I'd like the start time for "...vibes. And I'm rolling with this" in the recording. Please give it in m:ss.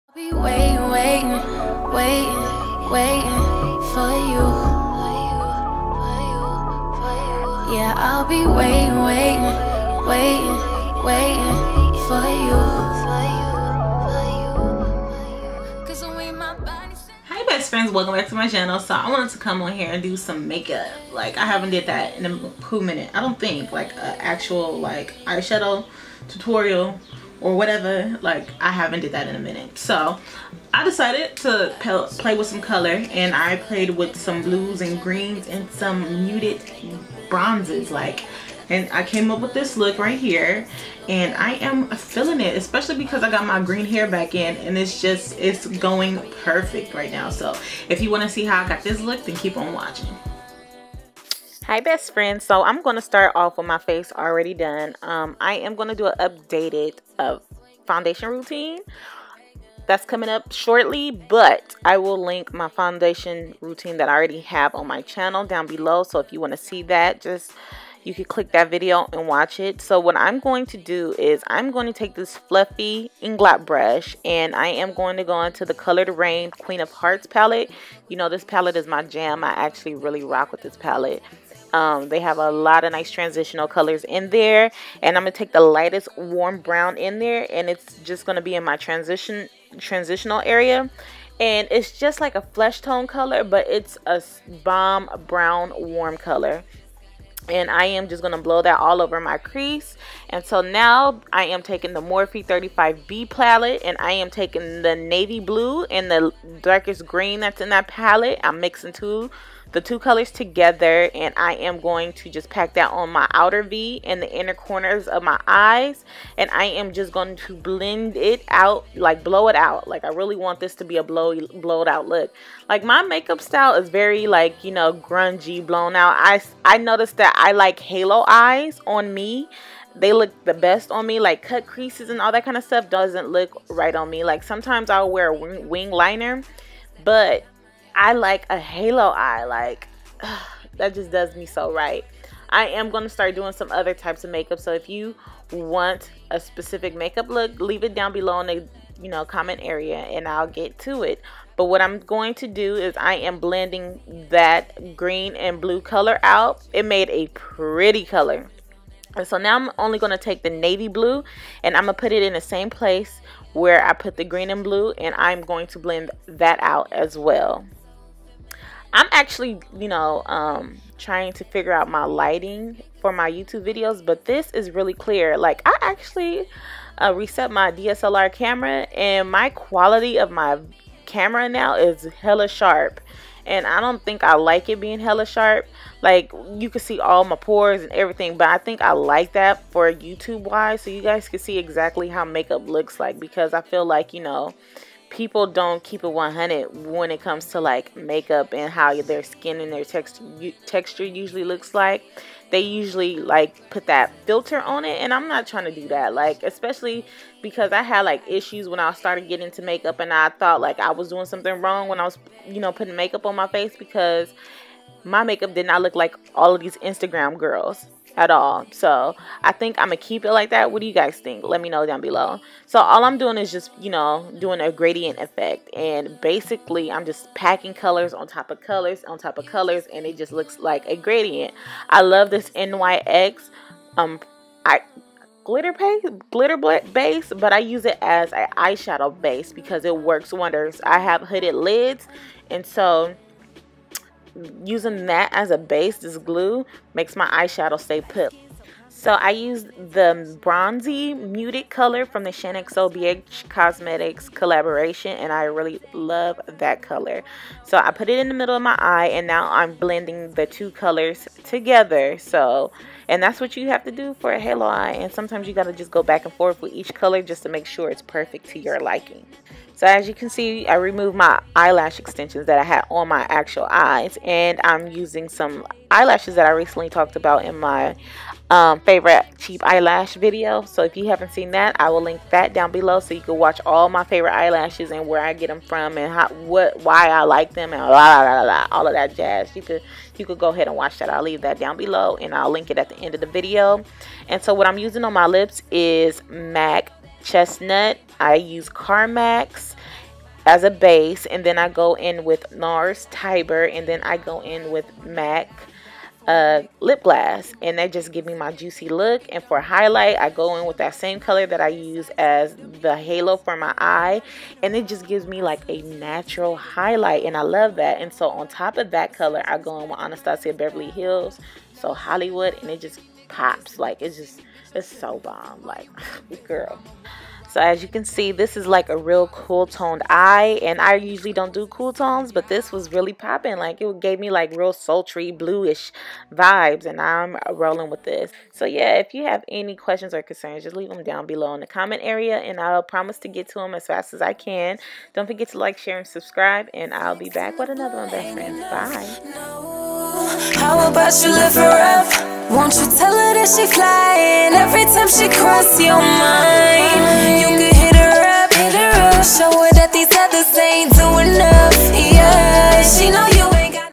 5:36.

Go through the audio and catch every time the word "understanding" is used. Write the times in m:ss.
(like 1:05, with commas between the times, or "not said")
not said.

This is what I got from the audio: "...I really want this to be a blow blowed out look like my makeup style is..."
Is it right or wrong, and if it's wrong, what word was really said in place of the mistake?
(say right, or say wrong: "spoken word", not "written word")
right.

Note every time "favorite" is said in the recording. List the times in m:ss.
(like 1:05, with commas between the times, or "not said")
4:38, 4:44.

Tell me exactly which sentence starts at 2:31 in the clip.
But what I'm going to do is I am blending that green and blue color out.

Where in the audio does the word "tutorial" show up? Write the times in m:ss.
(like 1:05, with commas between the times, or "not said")
0:26.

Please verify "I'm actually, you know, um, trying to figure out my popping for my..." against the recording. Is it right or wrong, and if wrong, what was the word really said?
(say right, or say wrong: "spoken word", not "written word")
wrong: "lighting", not "popping".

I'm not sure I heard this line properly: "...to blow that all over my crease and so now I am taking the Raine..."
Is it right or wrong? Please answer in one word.
wrong.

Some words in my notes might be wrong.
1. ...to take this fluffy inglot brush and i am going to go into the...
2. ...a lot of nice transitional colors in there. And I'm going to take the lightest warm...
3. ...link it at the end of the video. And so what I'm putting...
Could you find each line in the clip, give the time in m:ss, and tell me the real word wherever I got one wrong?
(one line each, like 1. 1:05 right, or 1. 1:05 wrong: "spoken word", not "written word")
1. 1:11 right
2. 1:22 right
3. 4:52 wrong: "using", not "putting".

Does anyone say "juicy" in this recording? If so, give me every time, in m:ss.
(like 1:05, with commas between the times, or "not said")
5:08.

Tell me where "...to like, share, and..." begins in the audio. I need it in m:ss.
5:45.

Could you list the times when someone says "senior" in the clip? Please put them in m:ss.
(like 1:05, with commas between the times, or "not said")
not said.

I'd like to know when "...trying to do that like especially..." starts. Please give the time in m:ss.
3:25.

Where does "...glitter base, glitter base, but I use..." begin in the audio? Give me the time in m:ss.
3:55.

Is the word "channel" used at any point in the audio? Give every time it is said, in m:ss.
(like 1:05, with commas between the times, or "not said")
0:18, 1:05.